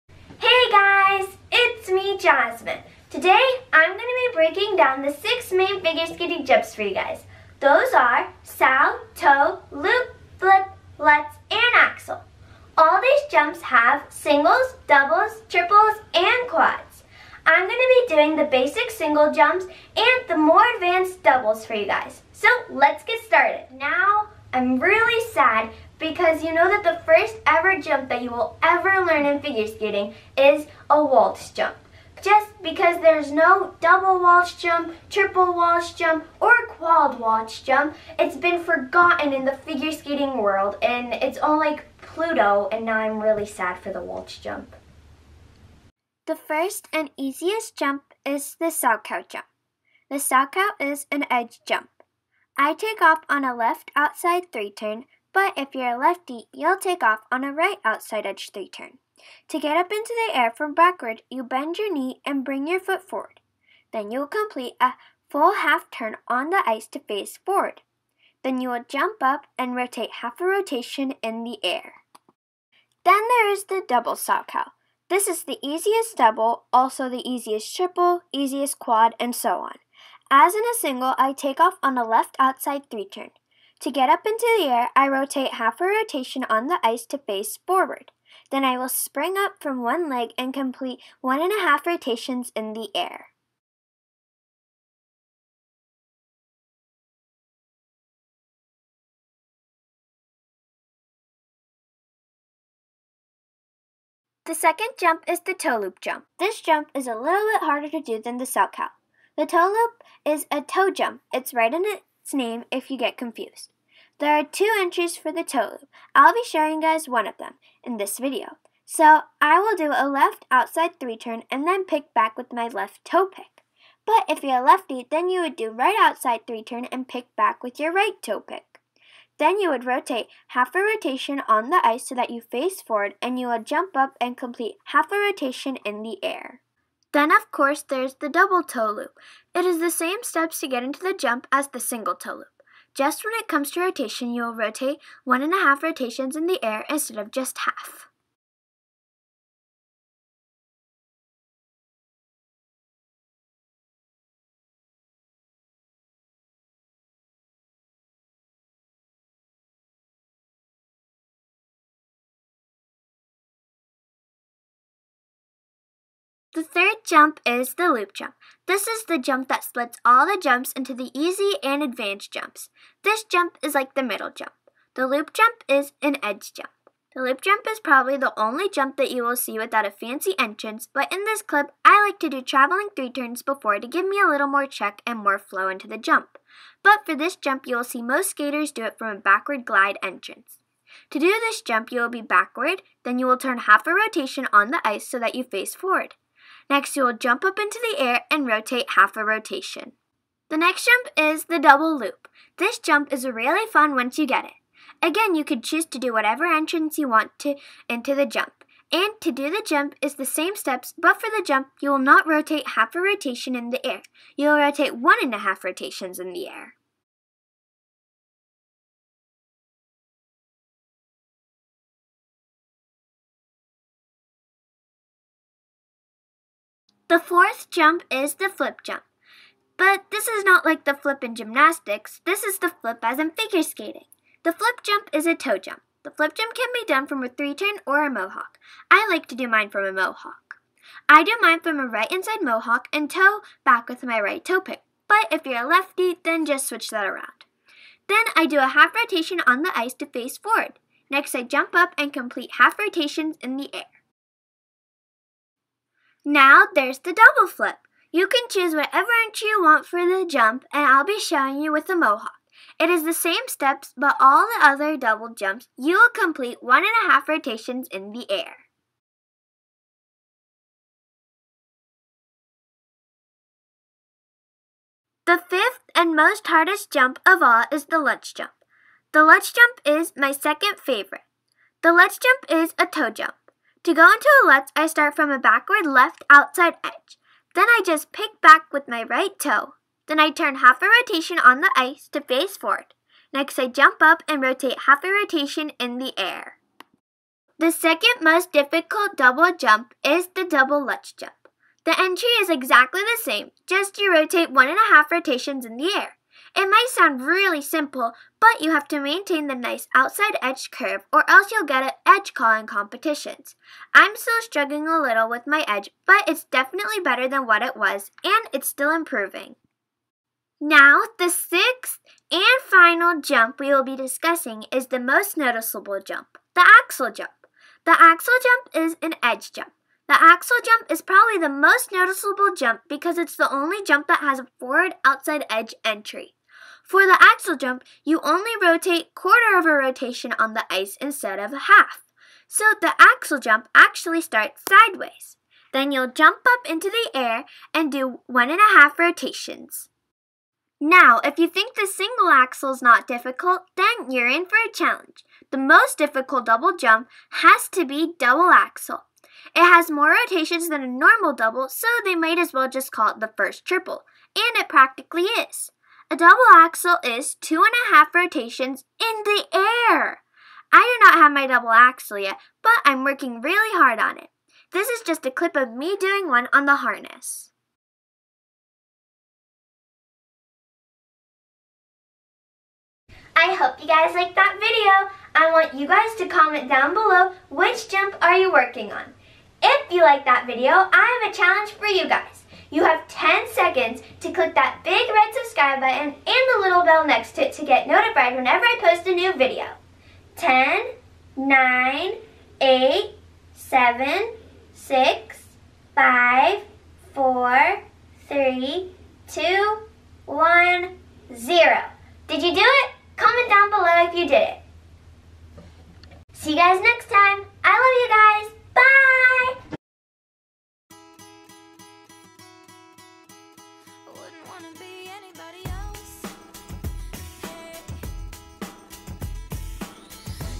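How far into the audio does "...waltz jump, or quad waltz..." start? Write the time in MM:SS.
00:35.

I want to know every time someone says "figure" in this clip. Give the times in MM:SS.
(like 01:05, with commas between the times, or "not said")
00:05, 00:29, 00:39, 03:53.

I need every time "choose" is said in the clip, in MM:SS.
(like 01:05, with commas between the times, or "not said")
03:25, 04:18.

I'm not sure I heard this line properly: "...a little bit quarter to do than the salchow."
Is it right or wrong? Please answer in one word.
wrong.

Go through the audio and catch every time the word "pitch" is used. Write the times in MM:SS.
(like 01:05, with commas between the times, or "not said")
not said.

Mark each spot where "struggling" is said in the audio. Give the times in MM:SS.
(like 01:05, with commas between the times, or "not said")
05:14.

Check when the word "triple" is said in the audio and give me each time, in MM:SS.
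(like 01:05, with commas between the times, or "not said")
00:15, 00:35, 01:17, 06:03.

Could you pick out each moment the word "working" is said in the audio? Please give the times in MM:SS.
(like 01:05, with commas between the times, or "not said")
06:13, 06:28.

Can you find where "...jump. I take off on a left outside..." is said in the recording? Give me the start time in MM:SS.
00:51.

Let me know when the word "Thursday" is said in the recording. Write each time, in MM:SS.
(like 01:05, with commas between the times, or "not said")
not said.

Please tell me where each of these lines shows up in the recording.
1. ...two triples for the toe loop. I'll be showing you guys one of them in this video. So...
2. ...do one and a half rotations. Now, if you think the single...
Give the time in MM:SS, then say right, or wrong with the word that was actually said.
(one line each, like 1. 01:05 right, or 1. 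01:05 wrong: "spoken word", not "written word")
1. 01:54 wrong: "entries", not "triples"
2. 05:47 right.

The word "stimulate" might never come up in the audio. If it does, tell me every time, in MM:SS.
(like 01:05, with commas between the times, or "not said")
not said.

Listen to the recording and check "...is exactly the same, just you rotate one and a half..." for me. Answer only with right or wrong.
right.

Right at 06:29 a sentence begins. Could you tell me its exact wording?
If you like that video, I have a challenge for you guys.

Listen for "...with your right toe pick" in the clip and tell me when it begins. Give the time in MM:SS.
02:07.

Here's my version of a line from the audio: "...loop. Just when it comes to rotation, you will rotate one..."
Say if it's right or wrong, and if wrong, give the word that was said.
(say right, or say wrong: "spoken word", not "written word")
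right.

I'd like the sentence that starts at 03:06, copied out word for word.
But for this jump, you will see most skaters do it from a backward glide entrance.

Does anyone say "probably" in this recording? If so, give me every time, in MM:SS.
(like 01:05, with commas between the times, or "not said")
02:57, 05:31.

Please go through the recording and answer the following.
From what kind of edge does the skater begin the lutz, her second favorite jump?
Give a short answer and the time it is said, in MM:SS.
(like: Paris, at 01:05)
Backward left outside edge, at 04:45.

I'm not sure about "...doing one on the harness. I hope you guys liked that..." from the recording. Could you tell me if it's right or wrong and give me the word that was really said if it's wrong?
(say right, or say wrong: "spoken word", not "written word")
right.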